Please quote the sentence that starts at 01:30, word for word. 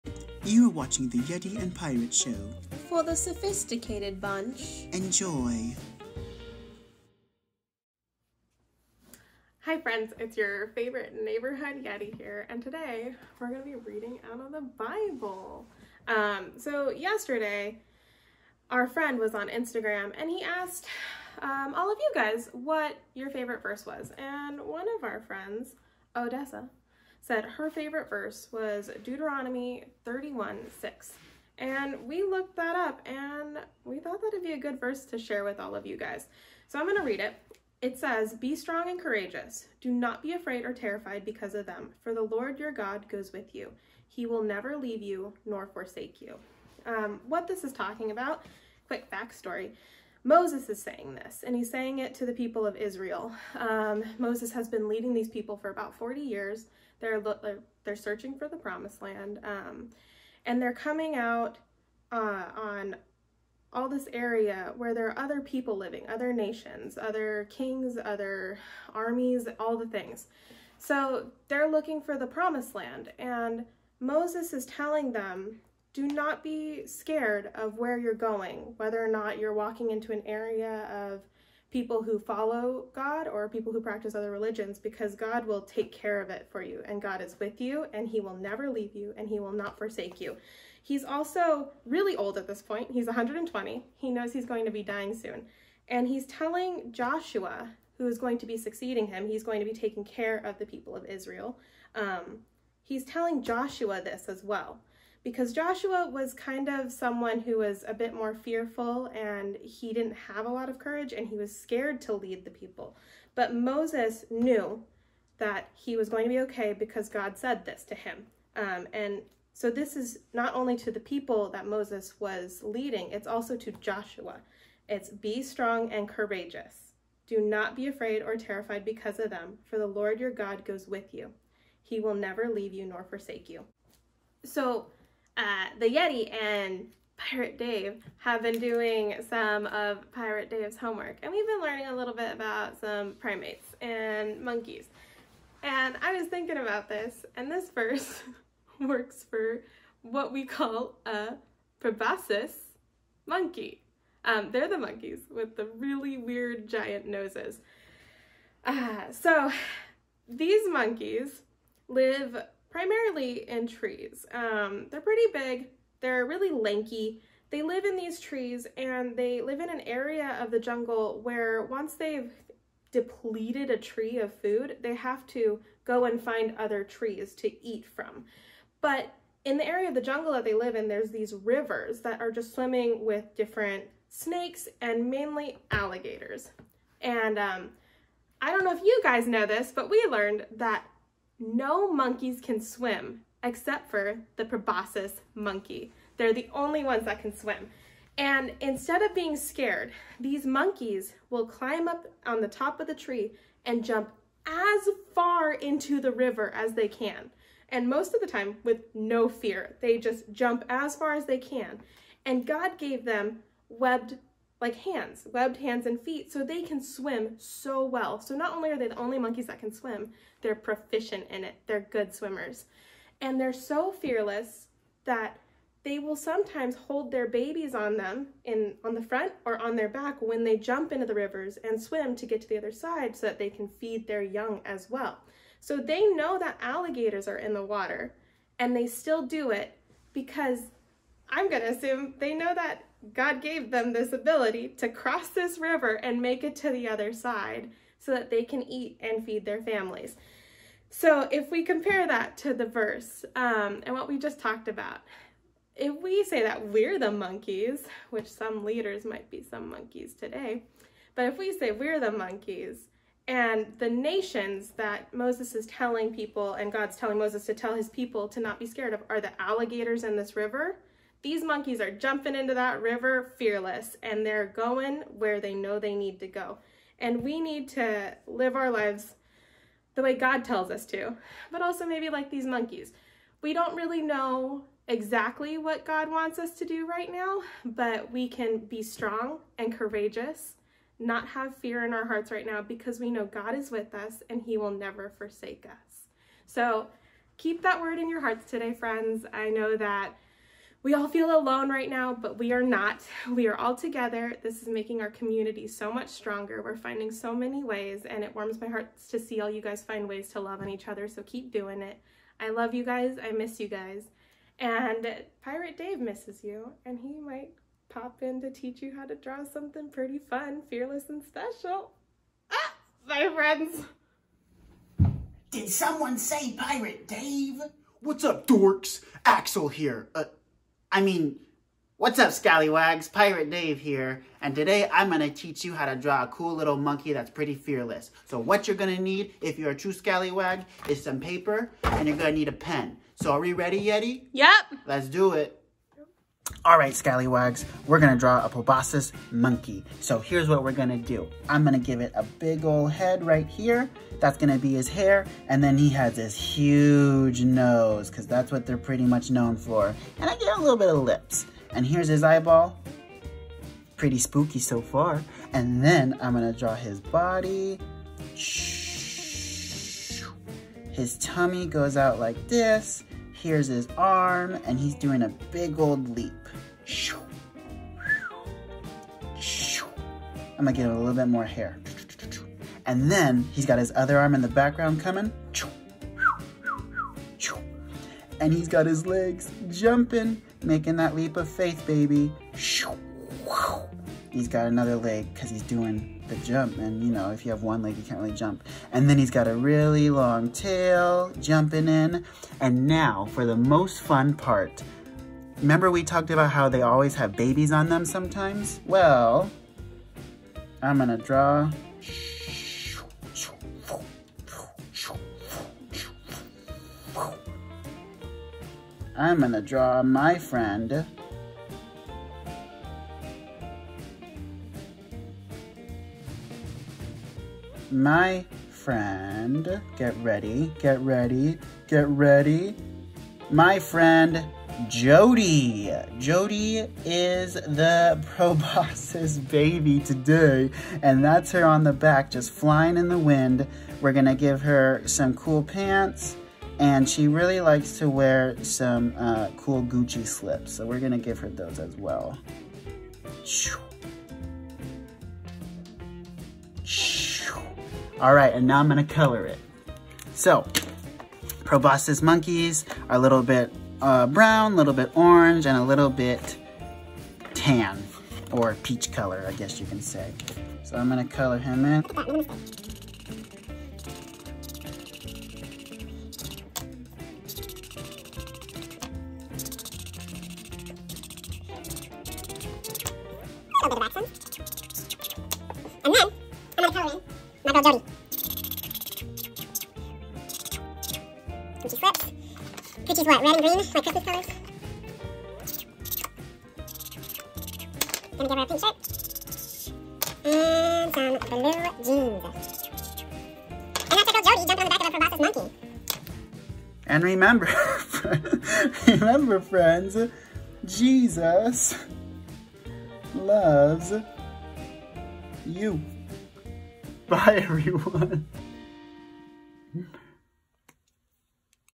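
He's also really old at this point.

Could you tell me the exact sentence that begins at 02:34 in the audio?
Um, they're the monkeys with the really weird giant noses.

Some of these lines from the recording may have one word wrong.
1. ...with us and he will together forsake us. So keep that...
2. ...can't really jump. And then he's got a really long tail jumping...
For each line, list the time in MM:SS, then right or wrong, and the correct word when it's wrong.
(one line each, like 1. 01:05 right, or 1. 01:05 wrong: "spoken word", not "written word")
1. 04:53 wrong: "never", not "together"
2. 06:38 right.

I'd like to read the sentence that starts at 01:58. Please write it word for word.
Um, and so this is not only to the people that Moses was leading, it's also to Joshua.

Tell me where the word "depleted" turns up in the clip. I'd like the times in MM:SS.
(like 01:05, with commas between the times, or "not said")
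02:52.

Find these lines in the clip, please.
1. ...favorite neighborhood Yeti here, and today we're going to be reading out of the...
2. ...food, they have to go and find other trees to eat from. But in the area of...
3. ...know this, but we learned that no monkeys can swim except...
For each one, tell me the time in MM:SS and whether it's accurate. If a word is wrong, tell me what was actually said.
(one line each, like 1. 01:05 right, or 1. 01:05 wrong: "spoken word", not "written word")
1. 00:10 right
2. 02:54 right
3. 03:09 right.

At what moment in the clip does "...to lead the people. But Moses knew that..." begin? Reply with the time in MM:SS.
01:52.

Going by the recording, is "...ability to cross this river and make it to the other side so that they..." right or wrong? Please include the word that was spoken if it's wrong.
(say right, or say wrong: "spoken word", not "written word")
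right.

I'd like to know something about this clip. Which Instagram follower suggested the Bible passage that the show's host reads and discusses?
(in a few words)
Odessa.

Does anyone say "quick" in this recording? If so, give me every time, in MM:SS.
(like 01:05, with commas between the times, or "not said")
00:48.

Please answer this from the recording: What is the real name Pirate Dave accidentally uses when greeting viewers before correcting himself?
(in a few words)
Axel.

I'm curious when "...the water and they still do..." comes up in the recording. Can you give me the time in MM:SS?
03:57.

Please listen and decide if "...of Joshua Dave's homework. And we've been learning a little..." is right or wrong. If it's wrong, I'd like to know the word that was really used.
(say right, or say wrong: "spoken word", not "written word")
wrong: "Pirate", not "Joshua".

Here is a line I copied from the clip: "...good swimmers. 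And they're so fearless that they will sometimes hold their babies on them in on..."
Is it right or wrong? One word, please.
right.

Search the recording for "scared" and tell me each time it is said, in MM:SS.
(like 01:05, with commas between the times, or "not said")
01:16, 01:51, 03:19, 04:28.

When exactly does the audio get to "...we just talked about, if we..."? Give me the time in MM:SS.
04:14.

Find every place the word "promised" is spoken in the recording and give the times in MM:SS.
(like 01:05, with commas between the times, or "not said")
00:58, 01:12.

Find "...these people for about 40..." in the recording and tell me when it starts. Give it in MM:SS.
00:55.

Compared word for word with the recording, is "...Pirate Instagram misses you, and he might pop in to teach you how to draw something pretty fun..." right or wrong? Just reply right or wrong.
wrong.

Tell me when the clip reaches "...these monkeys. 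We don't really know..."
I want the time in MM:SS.
04:42.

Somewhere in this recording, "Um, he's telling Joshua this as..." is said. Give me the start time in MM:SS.
01:41.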